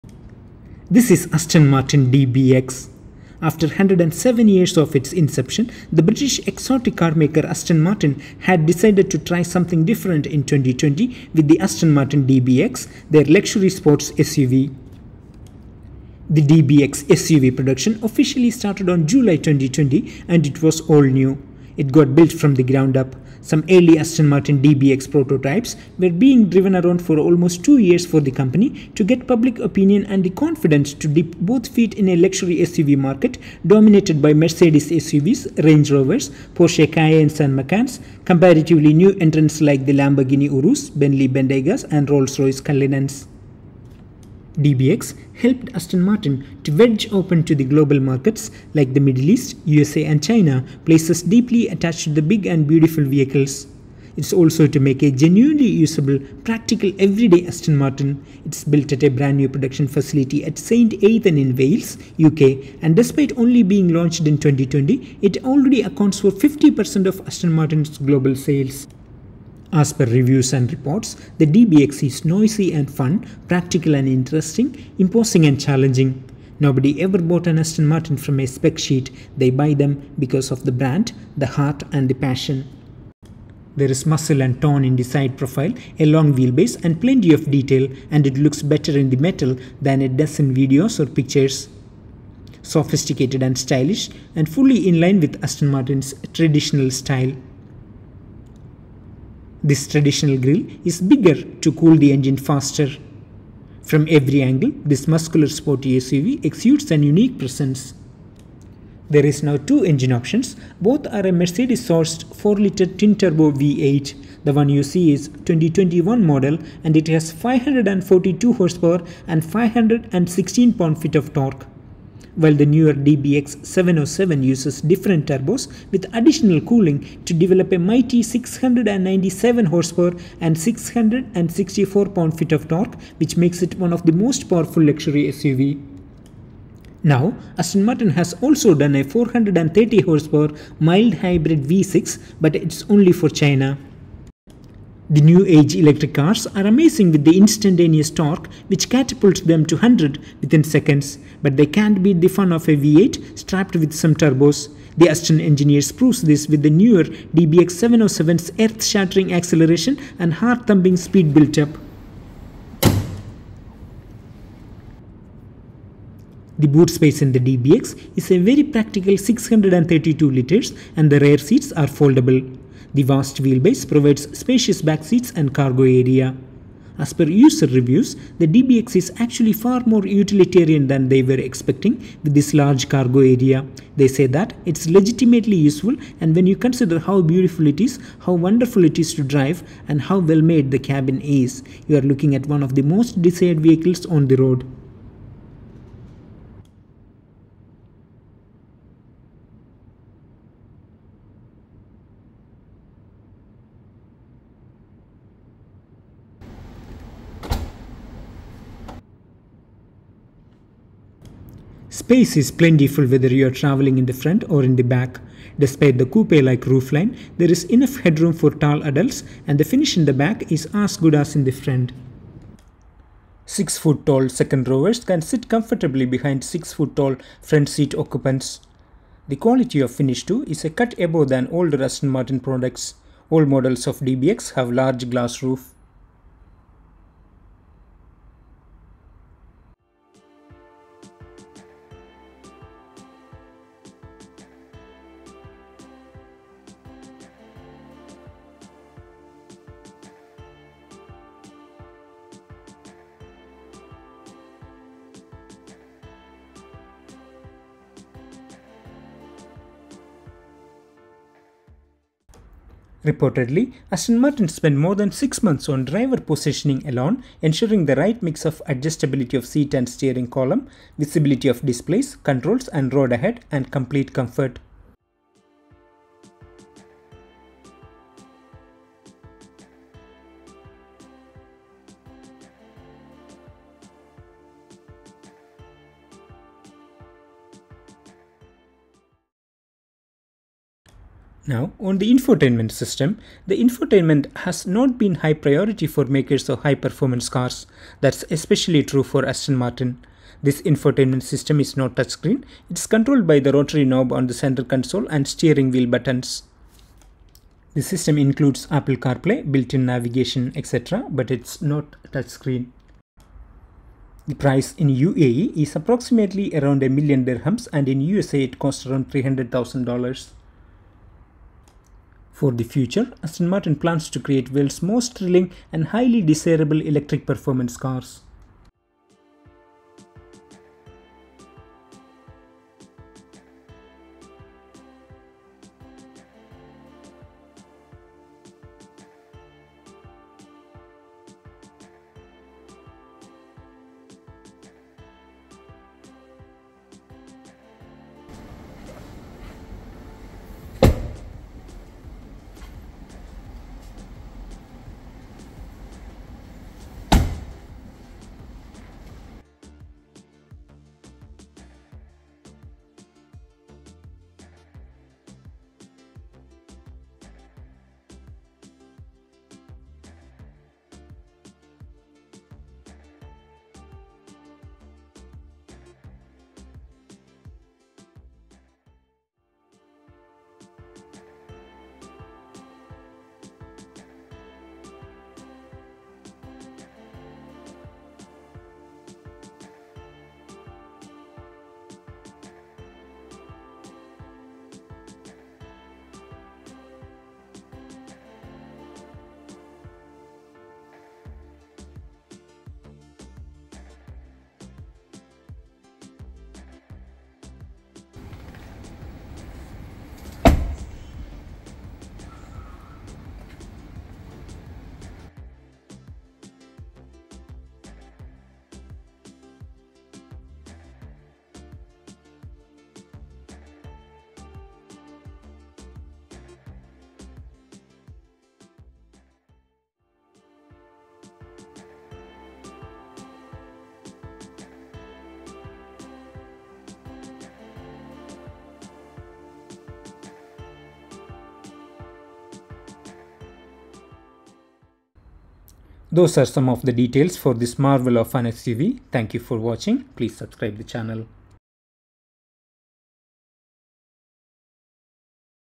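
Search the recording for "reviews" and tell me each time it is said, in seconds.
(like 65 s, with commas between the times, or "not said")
70 s, 177 s.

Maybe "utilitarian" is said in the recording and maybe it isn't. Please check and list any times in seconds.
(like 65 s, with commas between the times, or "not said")
180 s.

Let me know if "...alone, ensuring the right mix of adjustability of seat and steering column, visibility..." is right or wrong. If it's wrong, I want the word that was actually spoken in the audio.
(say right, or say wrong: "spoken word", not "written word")
right.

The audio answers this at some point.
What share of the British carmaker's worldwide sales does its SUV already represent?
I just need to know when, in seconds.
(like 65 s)
66 s.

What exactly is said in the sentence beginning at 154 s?
The Aston engineers proves this with the newer DBX 707's earth-shattering acceleration and heart-thumping speed built-up.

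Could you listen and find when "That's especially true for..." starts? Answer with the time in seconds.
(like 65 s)
297 s.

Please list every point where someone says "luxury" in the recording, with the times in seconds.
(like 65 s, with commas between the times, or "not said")
13 s, 32 s, 134 s.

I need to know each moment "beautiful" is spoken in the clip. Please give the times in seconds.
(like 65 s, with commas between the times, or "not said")
52 s, 187 s.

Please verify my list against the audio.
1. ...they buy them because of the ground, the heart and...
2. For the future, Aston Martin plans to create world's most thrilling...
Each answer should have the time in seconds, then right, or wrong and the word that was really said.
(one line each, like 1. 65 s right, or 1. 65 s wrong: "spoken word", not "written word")
1. 79 s wrong: "brand", not "ground"
2. 322 s right.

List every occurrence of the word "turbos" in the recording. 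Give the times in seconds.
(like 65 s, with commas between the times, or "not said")
112 s, 125 s, 154 s.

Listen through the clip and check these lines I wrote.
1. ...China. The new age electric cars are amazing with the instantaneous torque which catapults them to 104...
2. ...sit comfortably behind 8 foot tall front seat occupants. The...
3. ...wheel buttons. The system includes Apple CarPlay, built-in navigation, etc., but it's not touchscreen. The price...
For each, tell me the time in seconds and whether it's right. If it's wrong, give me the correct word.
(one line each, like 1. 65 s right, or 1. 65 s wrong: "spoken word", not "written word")
1. 143 s wrong: "100", not "104"
2. 225 s wrong: "6", not "8"
3. 305 s right.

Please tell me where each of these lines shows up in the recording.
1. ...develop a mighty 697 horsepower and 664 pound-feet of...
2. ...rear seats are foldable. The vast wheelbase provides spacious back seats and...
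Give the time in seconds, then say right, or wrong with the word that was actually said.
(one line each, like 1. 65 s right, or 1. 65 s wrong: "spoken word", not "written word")
1. 127 s right
2. 171 s right.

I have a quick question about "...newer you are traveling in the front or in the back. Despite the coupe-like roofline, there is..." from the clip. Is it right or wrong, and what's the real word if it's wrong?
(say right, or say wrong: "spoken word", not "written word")
wrong: "whether", not "newer".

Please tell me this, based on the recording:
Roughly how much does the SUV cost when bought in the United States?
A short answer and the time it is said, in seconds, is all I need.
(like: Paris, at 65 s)
$300,000, at 319 s.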